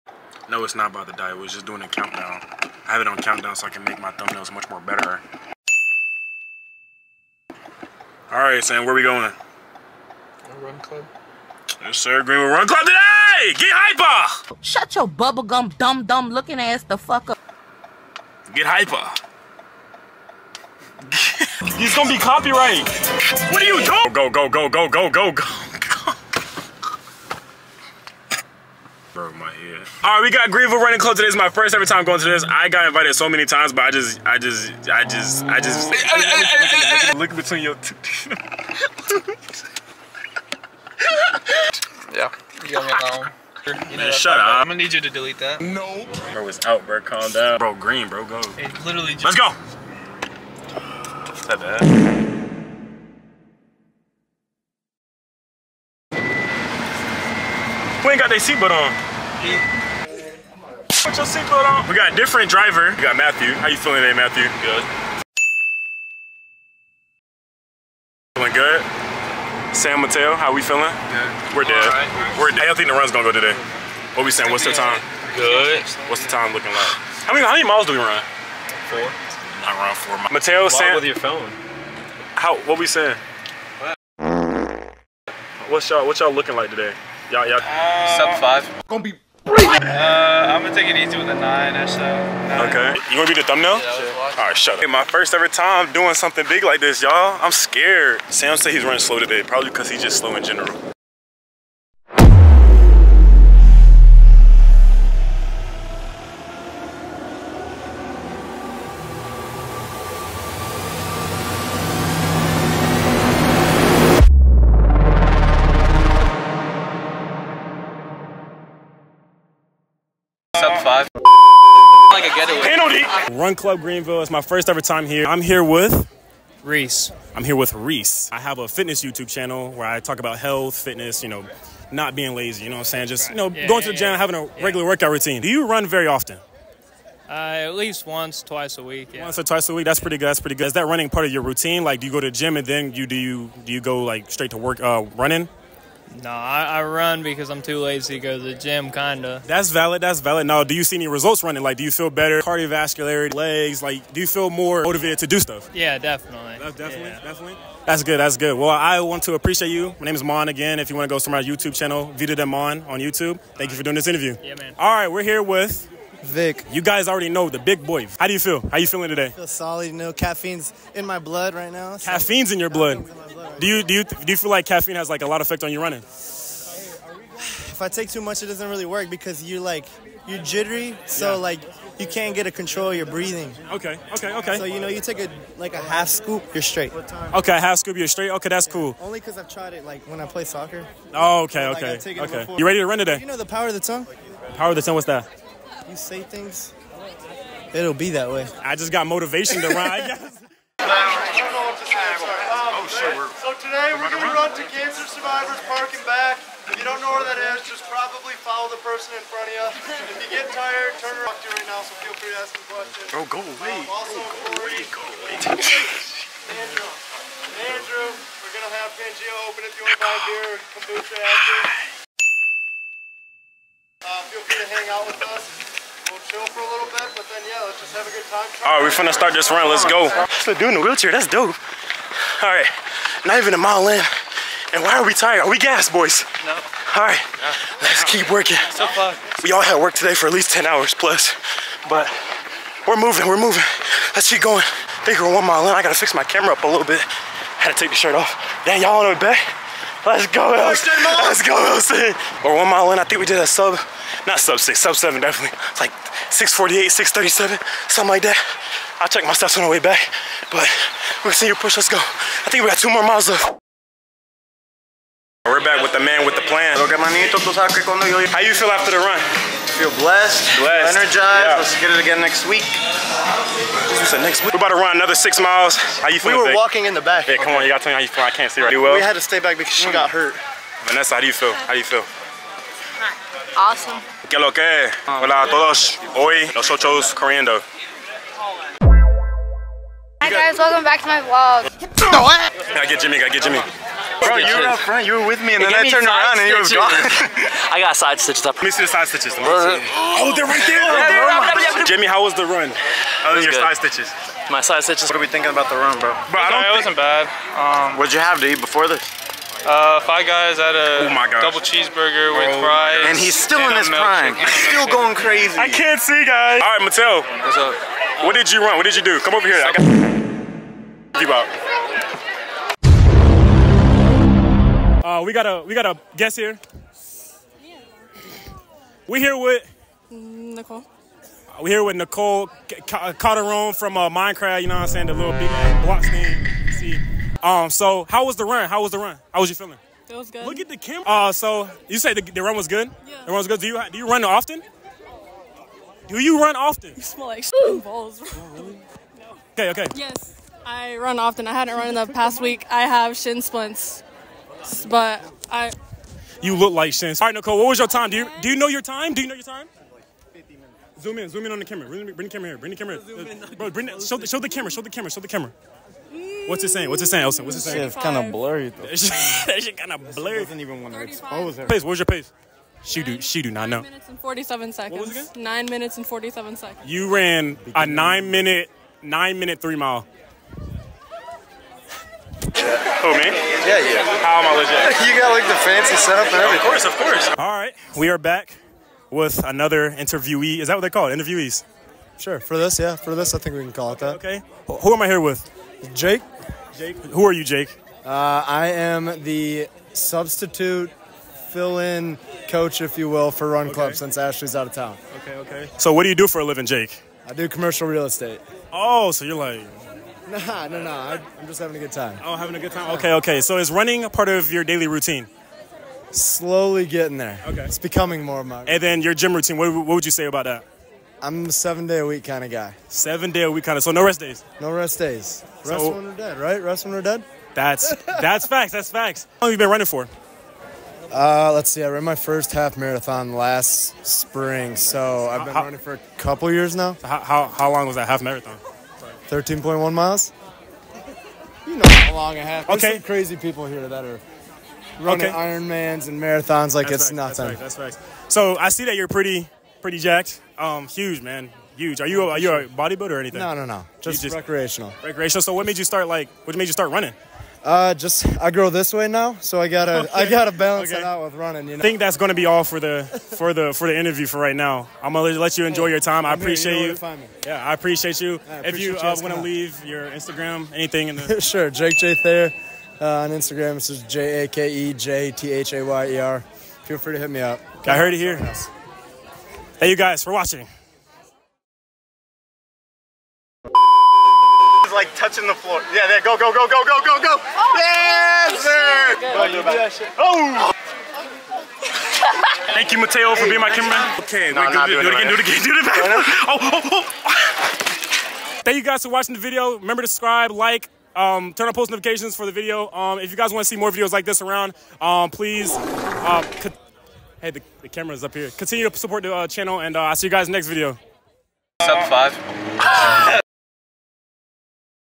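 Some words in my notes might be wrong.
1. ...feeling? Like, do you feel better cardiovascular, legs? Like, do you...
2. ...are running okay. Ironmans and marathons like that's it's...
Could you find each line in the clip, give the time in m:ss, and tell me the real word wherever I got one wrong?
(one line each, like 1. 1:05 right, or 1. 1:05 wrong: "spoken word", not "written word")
1. 2:31 wrong: "running", not "feeling"
2. 7:24 right.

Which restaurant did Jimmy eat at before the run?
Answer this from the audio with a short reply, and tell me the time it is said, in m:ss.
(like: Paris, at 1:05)
Five Guys, at 5:10.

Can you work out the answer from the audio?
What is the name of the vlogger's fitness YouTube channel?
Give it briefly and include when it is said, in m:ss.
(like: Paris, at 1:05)
Vita Demon, at 2:42.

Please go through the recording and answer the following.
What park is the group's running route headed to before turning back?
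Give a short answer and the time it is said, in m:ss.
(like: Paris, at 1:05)
Cancer Survivors Park, at 3:24.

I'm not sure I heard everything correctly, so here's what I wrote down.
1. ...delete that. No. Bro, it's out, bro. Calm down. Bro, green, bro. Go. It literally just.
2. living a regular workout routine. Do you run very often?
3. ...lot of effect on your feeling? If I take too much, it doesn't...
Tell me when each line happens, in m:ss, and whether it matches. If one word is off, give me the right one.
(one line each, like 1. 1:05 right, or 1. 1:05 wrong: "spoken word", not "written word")
1. 0:45 right
2. 2:14 wrong: "having", not "living"
3. 2:55 wrong: "running", not "feeling".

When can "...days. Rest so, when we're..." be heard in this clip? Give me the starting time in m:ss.
7:04.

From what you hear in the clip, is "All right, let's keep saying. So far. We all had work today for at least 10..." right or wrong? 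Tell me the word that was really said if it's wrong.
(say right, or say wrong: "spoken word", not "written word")
wrong: "working", not "saying".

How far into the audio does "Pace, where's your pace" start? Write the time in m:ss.
6:11.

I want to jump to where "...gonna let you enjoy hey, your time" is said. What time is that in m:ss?
7:45.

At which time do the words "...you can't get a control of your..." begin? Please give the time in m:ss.
3:01.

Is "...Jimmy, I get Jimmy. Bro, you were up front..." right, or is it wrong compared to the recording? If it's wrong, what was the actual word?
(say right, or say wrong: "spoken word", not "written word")
right.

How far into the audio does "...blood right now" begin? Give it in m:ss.
2:51.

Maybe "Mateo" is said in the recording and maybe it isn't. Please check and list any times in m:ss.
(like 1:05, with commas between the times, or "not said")
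1:10, 1:20, 8:12.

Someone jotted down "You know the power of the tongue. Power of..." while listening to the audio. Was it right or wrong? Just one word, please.
right.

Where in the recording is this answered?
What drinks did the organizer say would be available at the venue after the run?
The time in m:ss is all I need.
3:40.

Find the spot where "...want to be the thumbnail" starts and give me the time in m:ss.
1:33.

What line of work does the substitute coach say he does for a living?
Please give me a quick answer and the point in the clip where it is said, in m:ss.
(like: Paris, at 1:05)
Commercial real estate, at 6:47.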